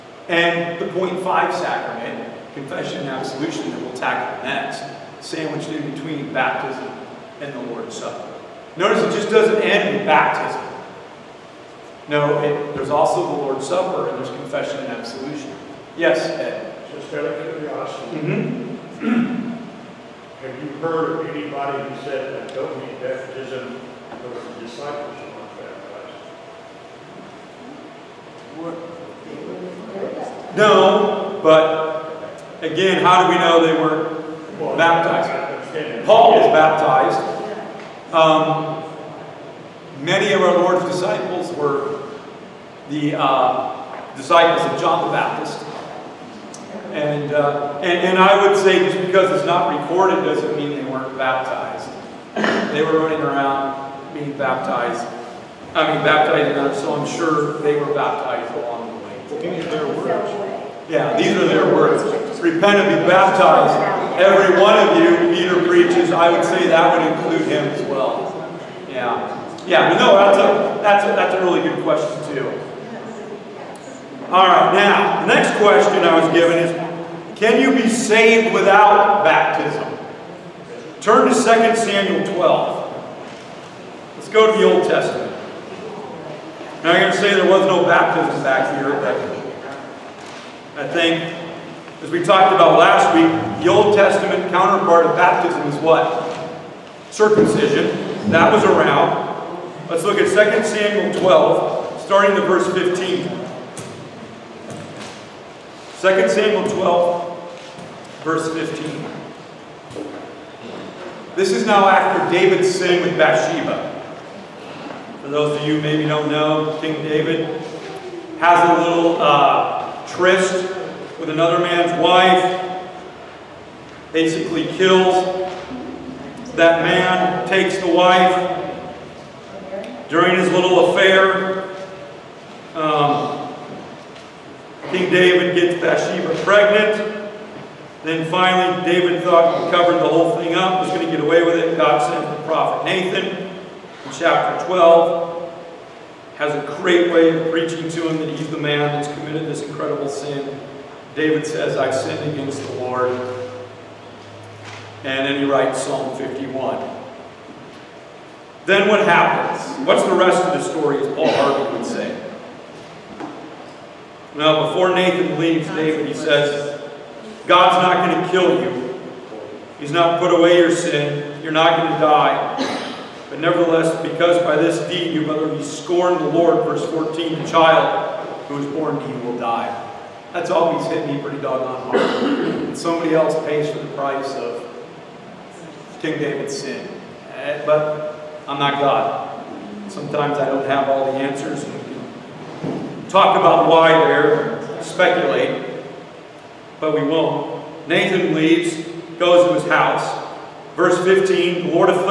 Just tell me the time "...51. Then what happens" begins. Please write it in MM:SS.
02:36.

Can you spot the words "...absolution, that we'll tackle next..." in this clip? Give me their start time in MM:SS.
00:03.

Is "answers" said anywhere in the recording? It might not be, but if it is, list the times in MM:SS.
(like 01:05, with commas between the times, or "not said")
03:11.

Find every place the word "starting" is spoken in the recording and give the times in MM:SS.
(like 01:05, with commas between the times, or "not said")
01:42.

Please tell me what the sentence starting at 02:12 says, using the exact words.
Um, King David gets Bathsheba pregnant.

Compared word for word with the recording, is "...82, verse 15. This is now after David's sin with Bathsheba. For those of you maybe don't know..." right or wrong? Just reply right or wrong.
wrong.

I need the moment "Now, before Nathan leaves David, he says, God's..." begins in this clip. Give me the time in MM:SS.
02:44.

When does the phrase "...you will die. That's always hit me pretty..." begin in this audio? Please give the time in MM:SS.
02:59.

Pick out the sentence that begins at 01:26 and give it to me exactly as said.
Now, you're going to say there was no baptism back here.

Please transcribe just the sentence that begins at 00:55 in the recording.
I mean, baptized in so I'm sure they were baptized along the way.